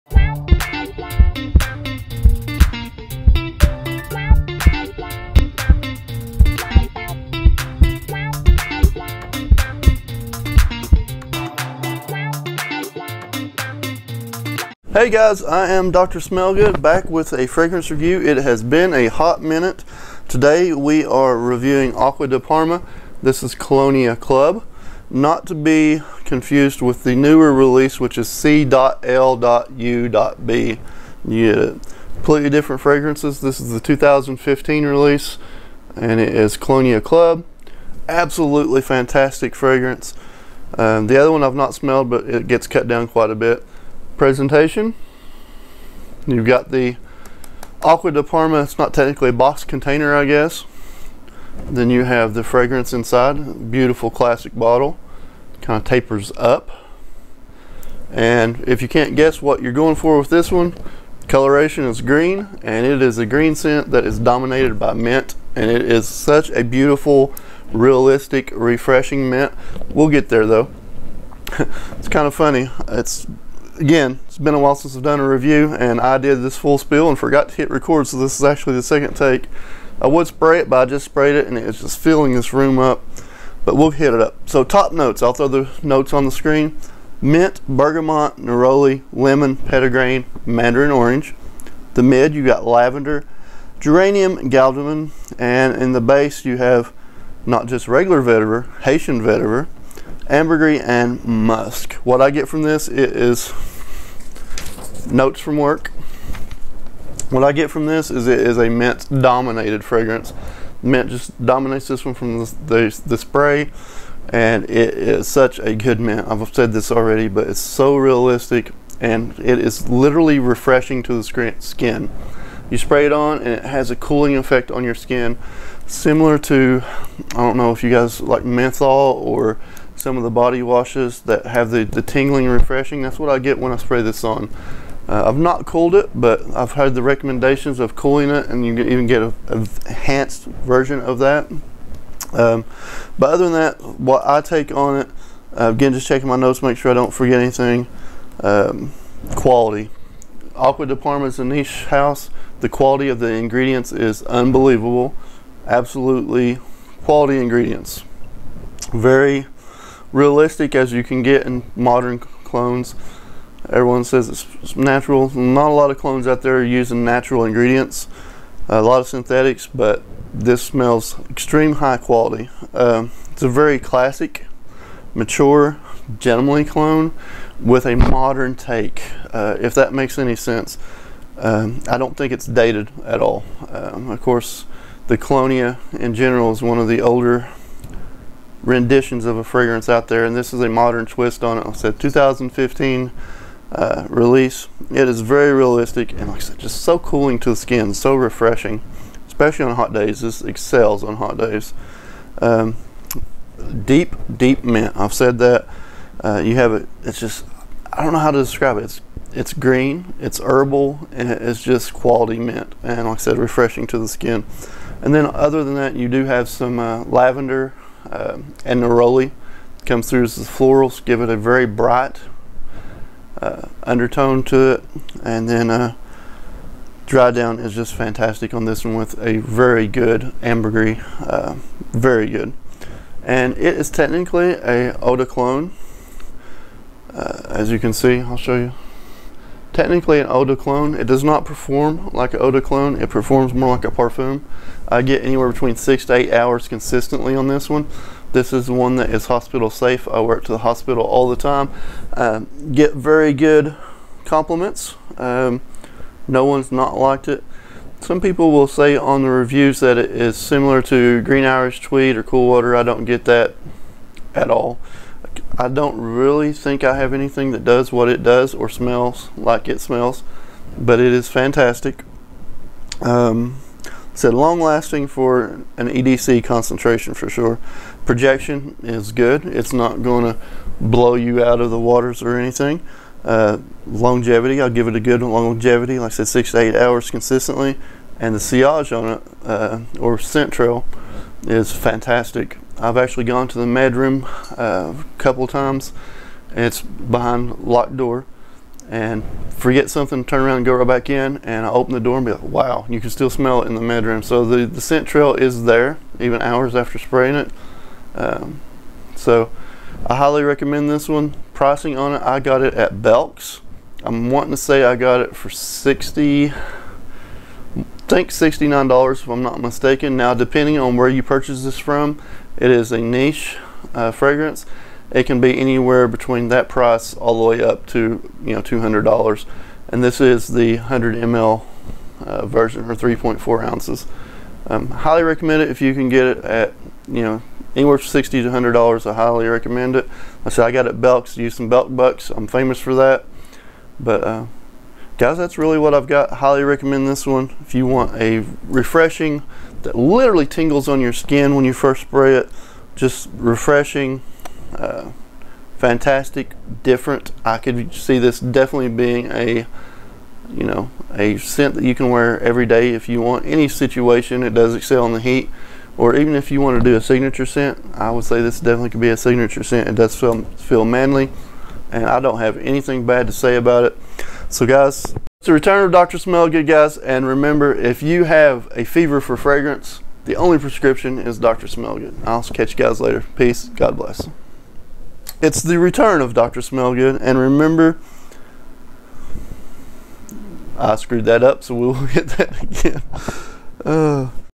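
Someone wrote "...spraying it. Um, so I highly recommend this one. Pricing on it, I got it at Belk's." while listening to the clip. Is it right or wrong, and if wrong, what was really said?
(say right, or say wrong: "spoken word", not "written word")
right.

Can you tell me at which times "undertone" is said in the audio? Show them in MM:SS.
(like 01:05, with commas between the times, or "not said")
03:43.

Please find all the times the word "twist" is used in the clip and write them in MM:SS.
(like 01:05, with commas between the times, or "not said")
03:11.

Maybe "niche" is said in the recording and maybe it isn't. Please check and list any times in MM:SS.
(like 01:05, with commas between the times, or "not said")
02:31, 05:22.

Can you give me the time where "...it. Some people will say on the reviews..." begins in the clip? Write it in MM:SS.
04:17.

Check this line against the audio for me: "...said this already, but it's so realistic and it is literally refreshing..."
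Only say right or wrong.
right.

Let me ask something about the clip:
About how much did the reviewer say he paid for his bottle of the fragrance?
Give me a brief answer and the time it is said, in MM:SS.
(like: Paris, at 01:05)
$69, at 05:18.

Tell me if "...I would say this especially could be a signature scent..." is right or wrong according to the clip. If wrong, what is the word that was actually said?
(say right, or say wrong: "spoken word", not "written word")
wrong: "definitely", not "especially".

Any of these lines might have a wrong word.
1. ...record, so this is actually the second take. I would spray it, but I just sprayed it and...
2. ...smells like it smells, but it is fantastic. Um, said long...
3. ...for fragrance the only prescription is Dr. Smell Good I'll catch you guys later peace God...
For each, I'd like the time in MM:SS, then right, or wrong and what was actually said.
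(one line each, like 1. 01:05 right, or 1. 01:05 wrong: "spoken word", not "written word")
1. 01:17 right
2. 04:28 right
3. 06:19 right.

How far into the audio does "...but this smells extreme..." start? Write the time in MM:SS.
02:49.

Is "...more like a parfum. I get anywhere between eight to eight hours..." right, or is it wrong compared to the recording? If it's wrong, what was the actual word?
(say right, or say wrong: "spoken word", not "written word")
wrong: "six", not "eight".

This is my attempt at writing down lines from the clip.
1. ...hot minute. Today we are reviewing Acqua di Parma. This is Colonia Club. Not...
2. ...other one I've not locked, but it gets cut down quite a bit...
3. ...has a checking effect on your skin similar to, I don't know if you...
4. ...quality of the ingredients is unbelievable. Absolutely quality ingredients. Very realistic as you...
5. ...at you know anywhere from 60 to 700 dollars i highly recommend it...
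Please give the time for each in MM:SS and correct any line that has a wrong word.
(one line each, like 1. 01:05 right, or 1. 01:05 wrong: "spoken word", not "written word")
1. 00:19 right
2. 00:41 wrong: "smelled", not "locked"
3. 02:03 wrong: "cooling", not "checking"
4. 02:32 right
5. 05:36 wrong: "100", not "700".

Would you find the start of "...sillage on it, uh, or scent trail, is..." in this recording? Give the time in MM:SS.
04:48.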